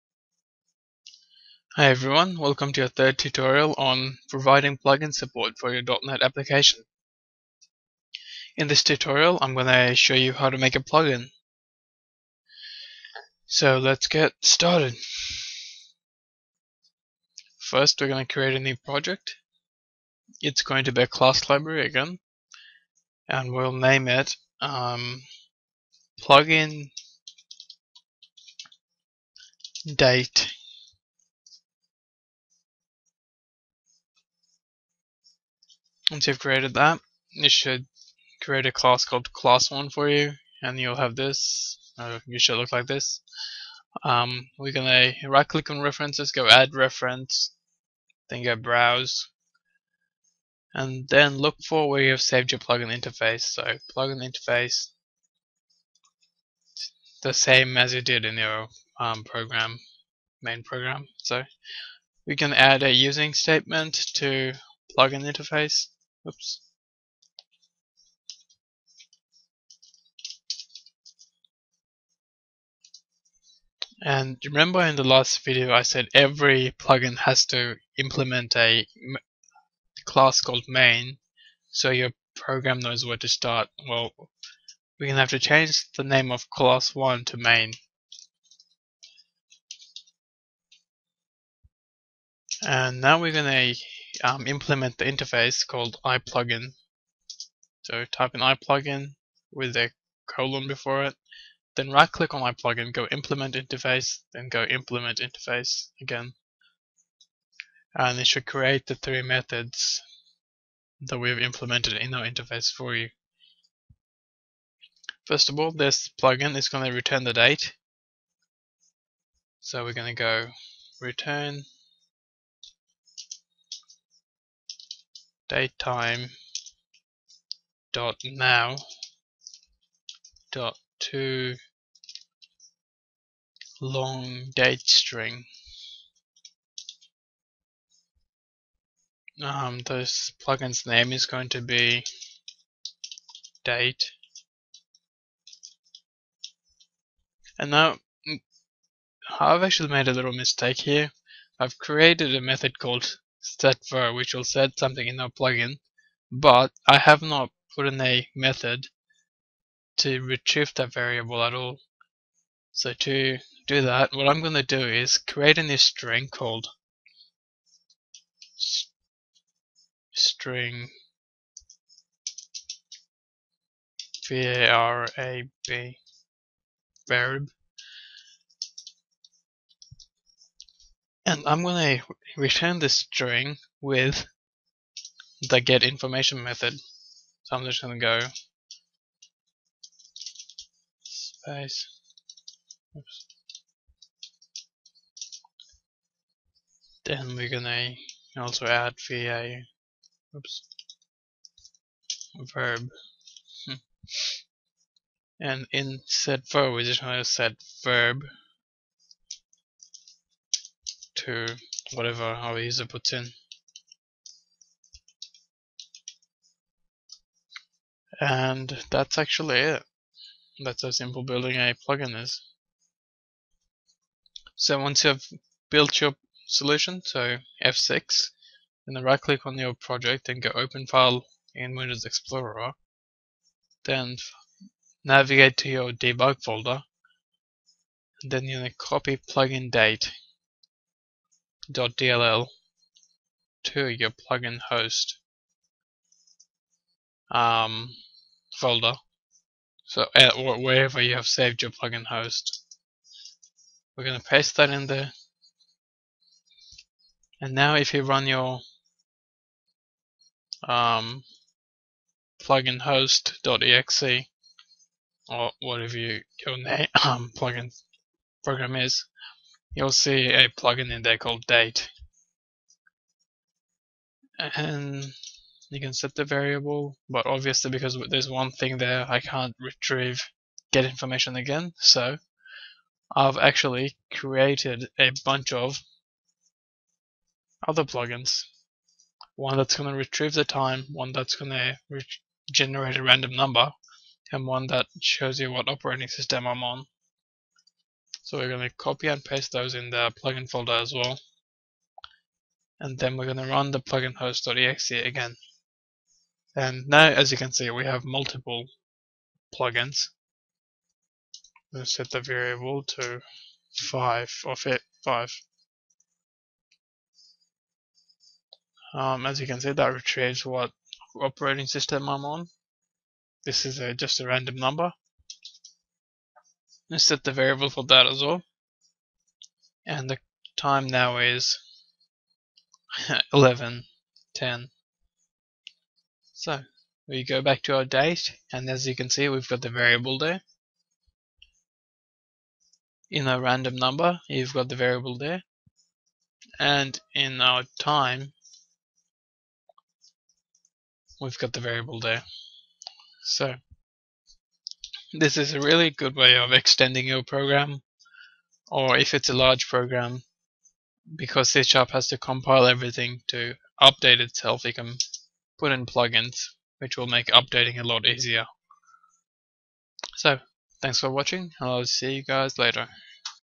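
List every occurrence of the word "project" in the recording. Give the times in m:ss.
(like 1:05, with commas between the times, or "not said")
0:18, 3:49.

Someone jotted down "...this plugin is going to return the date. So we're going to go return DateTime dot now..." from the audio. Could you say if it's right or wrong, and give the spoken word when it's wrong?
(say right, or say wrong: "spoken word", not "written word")
right.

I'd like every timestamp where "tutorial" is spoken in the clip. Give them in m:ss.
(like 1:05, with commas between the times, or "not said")
0:03, 0:08.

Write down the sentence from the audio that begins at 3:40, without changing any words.
That's how simple building a plugin is.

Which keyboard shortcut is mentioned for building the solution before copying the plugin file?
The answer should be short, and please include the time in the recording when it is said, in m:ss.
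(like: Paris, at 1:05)
F6, at 3:47.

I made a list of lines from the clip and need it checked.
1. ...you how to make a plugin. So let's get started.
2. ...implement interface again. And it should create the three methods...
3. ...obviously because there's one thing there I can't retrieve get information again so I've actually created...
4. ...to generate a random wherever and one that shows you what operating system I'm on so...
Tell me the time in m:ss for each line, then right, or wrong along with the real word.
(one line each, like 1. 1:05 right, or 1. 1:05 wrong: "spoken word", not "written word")
1. 0:10 right
2. 1:44 right
3. 4:37 right
4. 4:51 wrong: "number", not "wherever".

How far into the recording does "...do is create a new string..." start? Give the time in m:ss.
2:44.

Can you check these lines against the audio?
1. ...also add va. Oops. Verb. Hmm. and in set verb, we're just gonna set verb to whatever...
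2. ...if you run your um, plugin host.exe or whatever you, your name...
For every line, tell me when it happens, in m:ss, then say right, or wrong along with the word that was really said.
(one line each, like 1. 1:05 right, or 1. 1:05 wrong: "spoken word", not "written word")
1. 3:18 right
2. 4:17 right.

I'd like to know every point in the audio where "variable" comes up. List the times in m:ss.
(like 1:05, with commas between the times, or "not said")
2:40, 2:57, 4:36, 5:12, 5:27, 5:39, 5:44, 5:51.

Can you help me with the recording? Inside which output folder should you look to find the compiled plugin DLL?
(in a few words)
debug folder.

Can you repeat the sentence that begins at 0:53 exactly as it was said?
So plugin interface, the same as you did in your um, program, main program.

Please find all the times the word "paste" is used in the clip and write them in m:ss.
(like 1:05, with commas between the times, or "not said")
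4:14, 4:59.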